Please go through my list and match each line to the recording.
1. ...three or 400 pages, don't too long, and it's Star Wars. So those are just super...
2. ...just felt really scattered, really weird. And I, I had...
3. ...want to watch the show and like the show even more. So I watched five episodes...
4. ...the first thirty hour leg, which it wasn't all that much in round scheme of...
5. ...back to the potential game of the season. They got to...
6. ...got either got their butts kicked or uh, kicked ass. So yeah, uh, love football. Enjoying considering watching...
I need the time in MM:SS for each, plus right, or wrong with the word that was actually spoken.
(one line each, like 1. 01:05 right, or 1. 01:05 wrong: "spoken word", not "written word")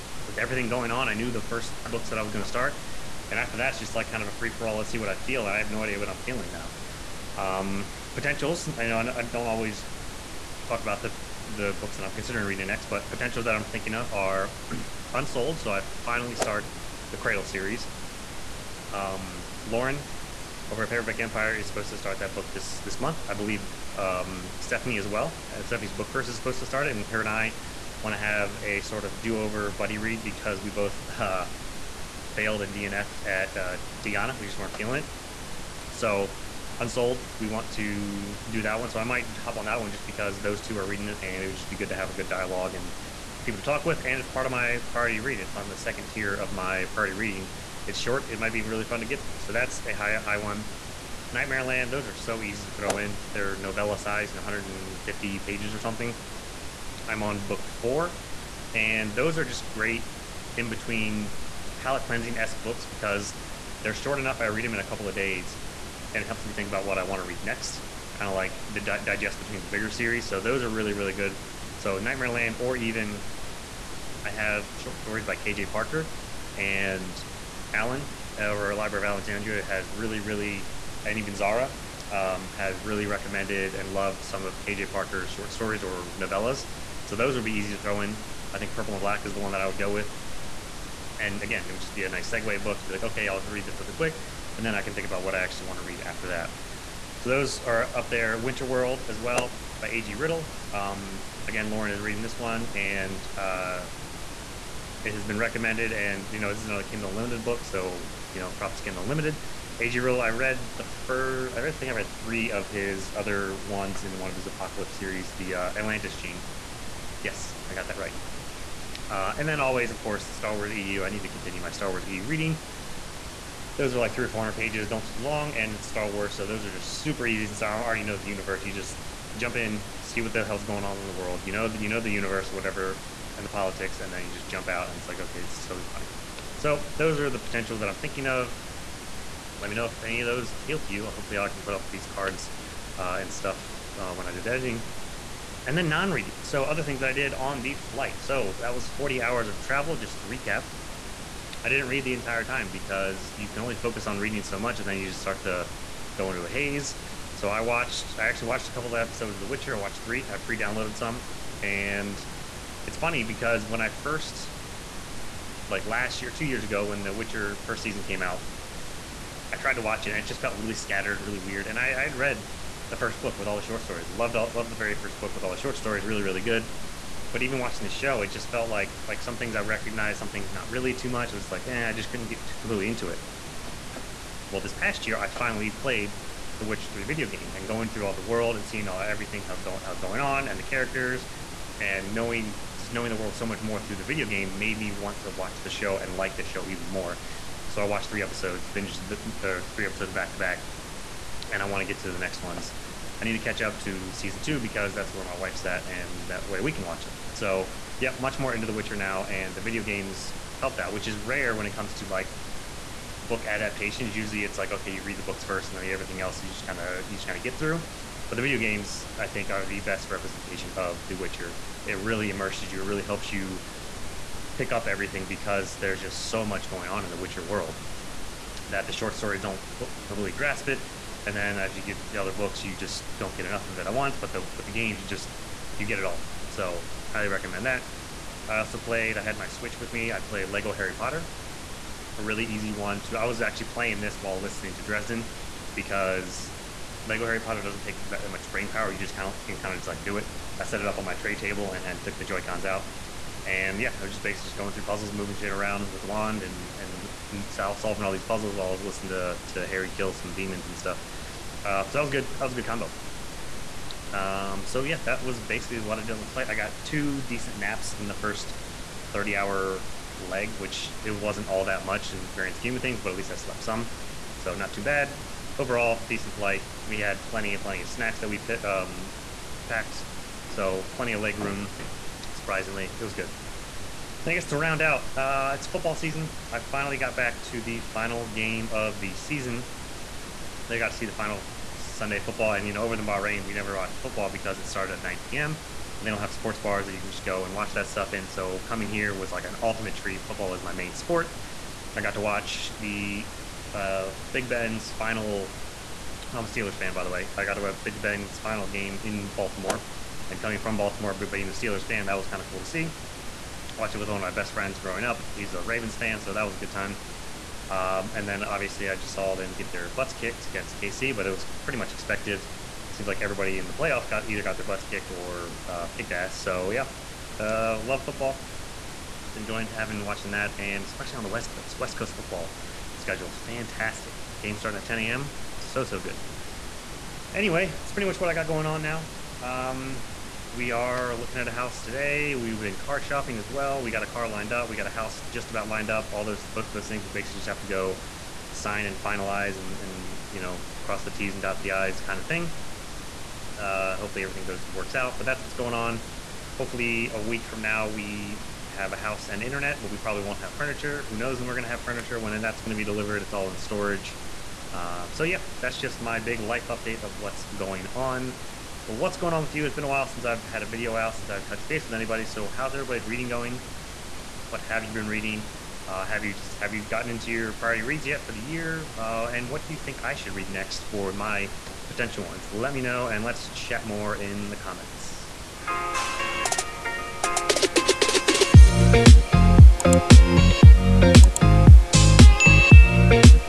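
1. 02:04 right
2. 02:50 right
3. 03:14 wrong: "three", not "five"
4. 04:28 wrong: "grand", not "round"
5. 04:47 wrong: "final", not "potential"
6. 05:24 wrong: "having", not "considering".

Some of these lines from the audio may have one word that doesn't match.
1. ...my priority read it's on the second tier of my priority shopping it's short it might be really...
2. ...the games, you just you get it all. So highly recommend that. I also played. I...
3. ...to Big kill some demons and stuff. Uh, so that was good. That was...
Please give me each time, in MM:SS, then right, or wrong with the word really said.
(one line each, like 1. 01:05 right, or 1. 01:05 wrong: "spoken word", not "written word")
1. 00:44 wrong: "reading", not "shopping"
2. 03:54 right
3. 04:19 wrong: "Harry", not "Big".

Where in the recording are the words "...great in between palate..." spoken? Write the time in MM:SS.
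00:59.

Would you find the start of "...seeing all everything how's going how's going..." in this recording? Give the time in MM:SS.
03:08.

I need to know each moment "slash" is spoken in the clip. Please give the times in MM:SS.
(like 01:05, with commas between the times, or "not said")
not said.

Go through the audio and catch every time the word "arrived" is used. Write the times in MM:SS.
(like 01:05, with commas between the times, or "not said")
not said.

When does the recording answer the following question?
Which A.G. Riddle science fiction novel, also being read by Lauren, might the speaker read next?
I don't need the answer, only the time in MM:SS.
01:38.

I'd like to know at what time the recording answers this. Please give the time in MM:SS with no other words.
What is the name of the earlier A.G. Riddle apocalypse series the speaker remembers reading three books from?
01:55.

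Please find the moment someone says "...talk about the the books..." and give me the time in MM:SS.
00:10.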